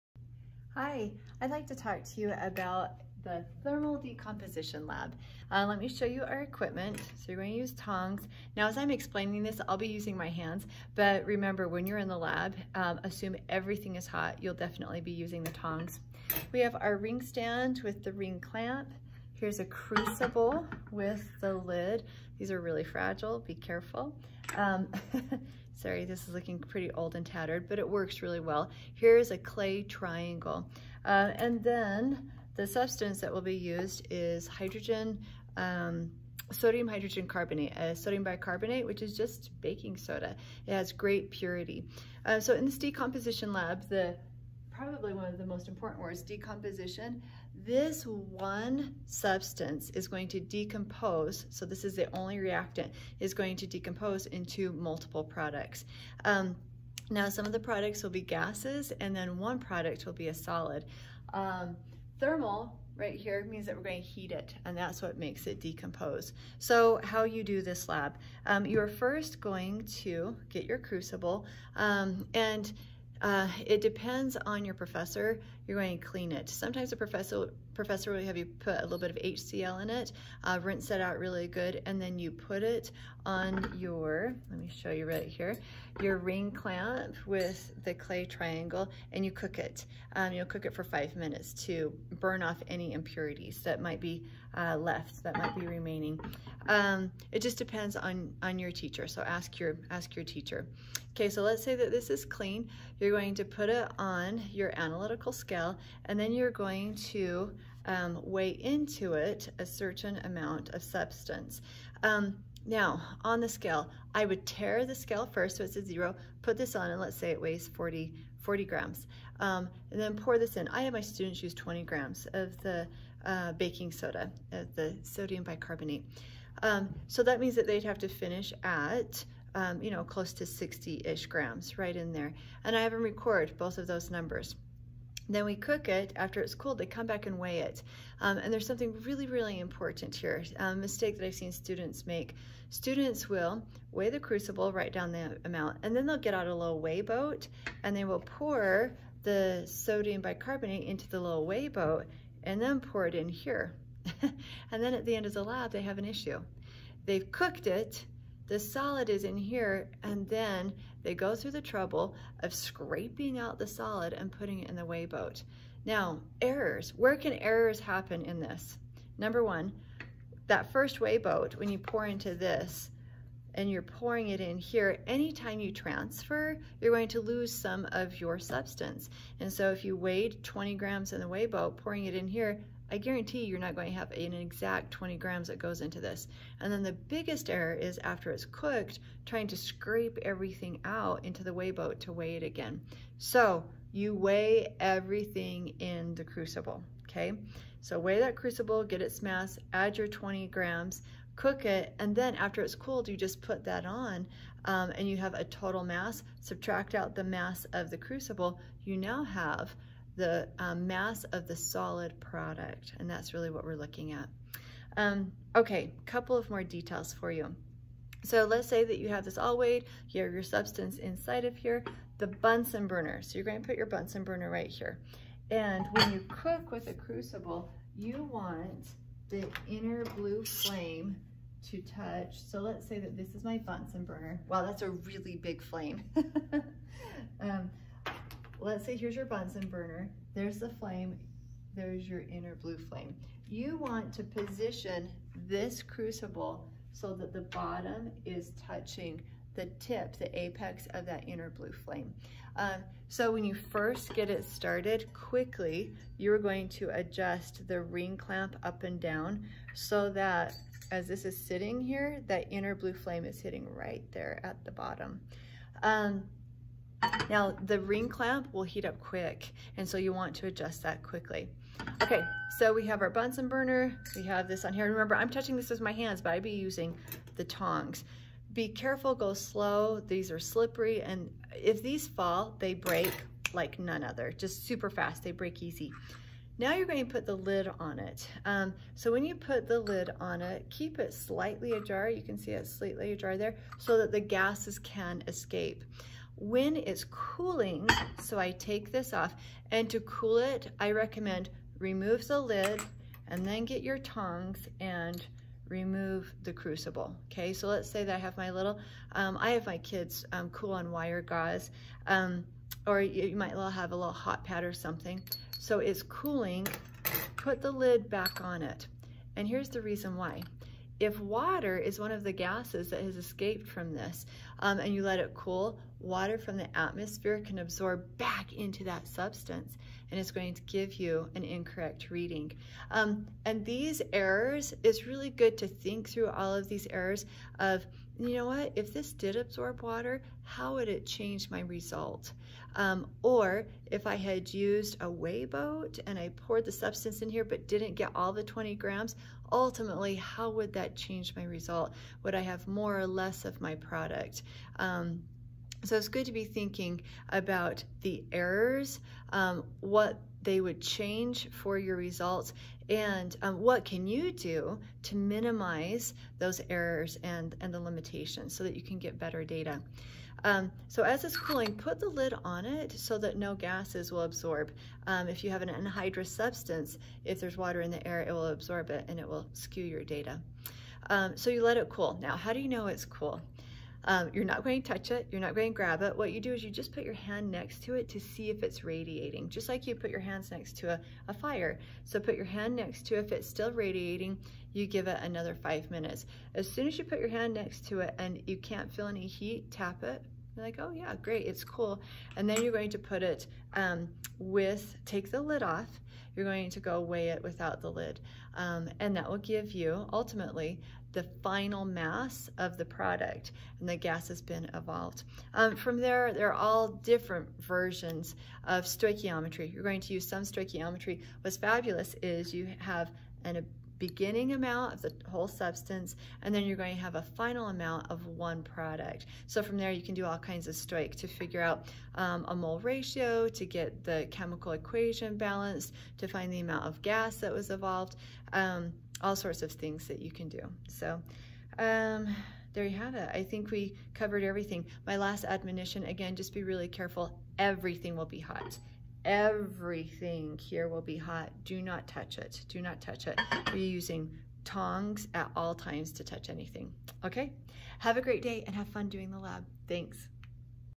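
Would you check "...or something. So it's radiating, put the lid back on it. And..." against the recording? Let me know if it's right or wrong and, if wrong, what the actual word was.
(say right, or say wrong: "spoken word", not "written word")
wrong: "cooling", not "radiating".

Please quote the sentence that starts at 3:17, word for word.
So weigh that crucible, get its mass.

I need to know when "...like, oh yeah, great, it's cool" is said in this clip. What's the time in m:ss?
6:40.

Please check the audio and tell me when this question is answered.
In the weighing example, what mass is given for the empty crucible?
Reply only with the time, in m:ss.
1:58.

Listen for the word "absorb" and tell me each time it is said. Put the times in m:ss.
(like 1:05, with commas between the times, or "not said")
5:27, 5:39, 6:14, 6:18.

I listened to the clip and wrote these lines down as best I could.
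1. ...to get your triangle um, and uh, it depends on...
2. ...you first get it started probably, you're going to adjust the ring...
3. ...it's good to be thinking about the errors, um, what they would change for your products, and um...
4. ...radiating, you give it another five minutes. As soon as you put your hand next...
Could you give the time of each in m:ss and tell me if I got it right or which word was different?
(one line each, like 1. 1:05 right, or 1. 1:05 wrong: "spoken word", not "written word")
1. 1:10 wrong: "crucible", not "triangle"
2. 4:13 wrong: "quickly", not "probably"
3. 5:55 wrong: "results", not "products"
4. 6:33 right.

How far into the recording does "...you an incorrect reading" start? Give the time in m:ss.
5:30.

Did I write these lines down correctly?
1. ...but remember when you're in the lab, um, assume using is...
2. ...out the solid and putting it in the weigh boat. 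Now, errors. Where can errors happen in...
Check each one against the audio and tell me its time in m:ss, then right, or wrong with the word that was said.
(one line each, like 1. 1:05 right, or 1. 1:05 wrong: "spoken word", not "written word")
1. 0:10 wrong: "everything", not "using"
2. 2:43 right.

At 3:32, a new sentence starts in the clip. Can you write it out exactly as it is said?
And that's really what we're looking at.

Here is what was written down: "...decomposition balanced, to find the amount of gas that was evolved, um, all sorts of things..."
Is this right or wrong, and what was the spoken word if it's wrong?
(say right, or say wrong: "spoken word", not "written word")
wrong: "equation", not "decomposition".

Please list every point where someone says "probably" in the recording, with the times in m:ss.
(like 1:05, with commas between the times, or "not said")
0:44.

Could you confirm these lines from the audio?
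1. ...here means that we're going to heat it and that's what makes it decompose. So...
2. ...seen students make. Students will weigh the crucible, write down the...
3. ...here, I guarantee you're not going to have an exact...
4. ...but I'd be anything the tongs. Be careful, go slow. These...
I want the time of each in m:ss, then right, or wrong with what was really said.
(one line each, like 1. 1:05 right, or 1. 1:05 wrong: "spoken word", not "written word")
1. 1:03 right
2. 2:21 right
3. 3:02 right
4. 4:36 wrong: "using", not "anything".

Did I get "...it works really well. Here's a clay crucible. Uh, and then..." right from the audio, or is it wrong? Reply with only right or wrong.
wrong.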